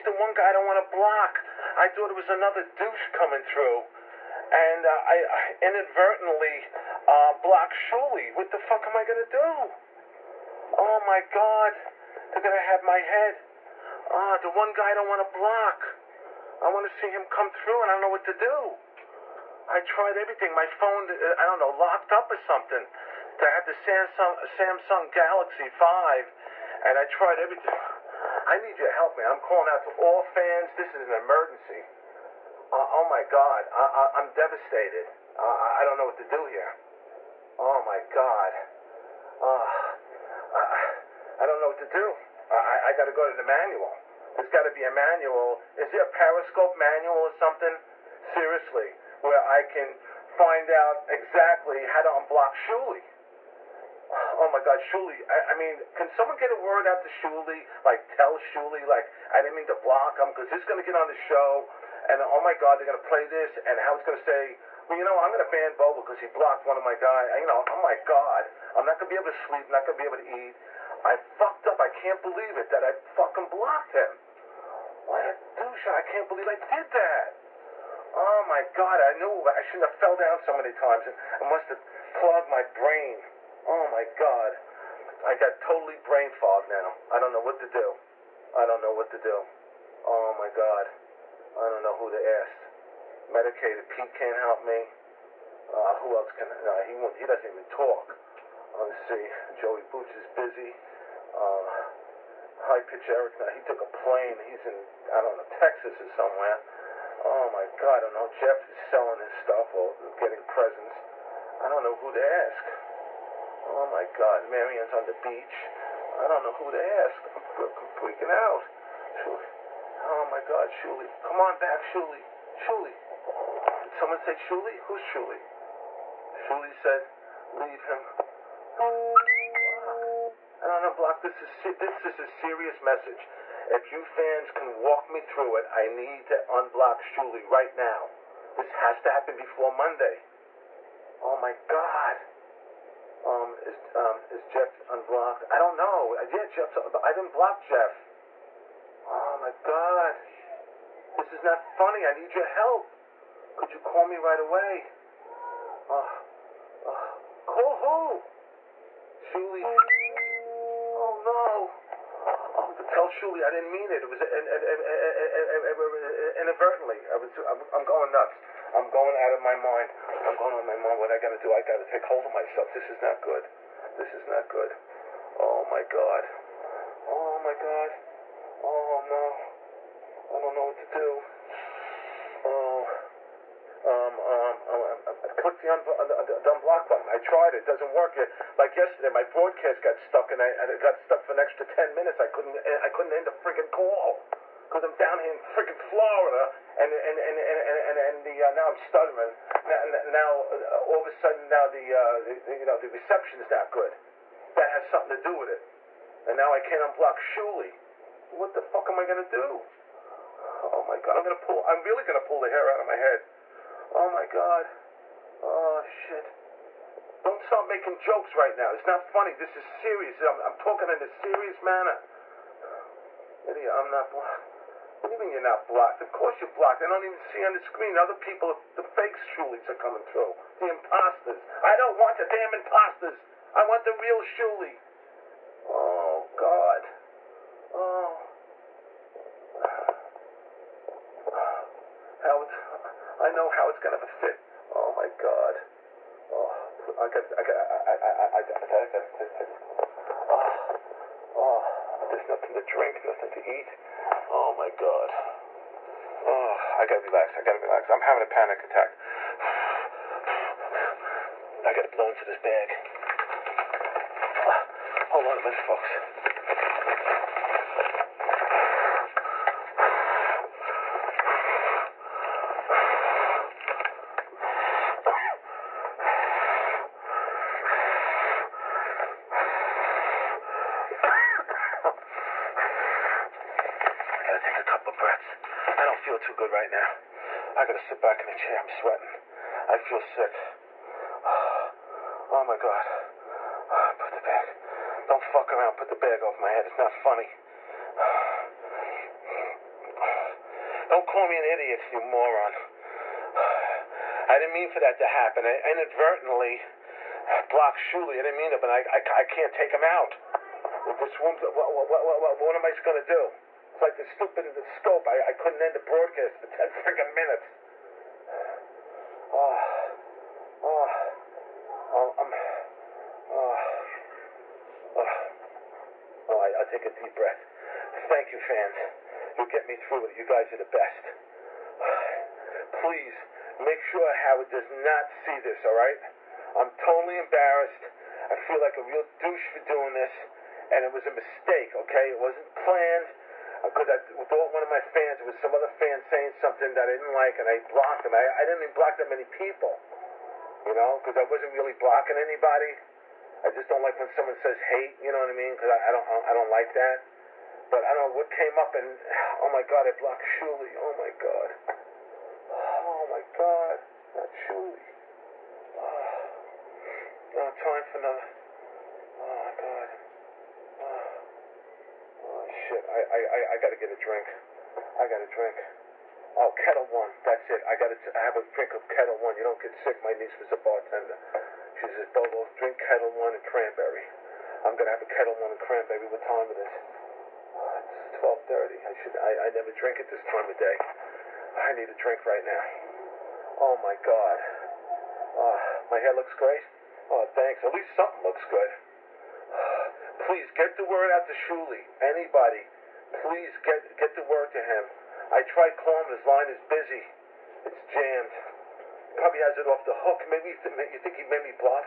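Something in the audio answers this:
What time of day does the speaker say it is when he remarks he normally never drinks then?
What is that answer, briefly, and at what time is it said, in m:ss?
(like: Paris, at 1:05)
12:30, at 6:28.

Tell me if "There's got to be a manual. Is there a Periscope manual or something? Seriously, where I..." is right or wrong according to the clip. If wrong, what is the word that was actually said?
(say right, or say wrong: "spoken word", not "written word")
right.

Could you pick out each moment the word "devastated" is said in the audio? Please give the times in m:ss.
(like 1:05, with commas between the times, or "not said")
0:34.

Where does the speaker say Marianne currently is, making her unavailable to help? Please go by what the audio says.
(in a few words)
The beach.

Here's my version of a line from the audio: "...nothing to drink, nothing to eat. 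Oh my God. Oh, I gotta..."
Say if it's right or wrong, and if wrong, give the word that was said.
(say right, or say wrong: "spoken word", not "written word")
right.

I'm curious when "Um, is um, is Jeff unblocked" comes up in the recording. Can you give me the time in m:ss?
2:23.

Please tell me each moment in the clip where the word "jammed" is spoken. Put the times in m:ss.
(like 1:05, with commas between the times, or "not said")
6:47.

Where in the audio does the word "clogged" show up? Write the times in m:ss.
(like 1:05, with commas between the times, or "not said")
1:22.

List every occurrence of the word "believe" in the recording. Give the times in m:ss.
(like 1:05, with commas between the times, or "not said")
1:12, 1:16.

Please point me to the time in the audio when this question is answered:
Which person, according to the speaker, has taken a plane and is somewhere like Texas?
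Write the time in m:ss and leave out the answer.
1:42.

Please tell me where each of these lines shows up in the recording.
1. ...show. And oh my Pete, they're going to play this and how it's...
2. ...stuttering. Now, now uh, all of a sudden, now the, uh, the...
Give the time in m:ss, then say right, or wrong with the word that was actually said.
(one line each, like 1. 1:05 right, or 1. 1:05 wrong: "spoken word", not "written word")
1. 1:01 wrong: "God", not "Pete"
2. 3:18 right.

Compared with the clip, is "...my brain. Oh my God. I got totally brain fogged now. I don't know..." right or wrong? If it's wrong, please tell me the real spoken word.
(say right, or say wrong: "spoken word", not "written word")
right.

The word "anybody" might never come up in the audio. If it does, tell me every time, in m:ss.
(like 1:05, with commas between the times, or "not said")
5:52, 6:42.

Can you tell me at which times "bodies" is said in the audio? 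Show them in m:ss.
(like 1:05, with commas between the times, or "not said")
not said.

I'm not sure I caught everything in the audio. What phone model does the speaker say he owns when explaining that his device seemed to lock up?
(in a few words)
Samsung Galaxy Five.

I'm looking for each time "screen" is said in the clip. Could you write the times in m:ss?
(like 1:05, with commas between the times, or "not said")
3:47.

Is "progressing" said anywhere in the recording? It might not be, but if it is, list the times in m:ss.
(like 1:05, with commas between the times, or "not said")
not said.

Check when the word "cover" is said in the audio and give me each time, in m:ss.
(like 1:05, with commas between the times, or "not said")
not said.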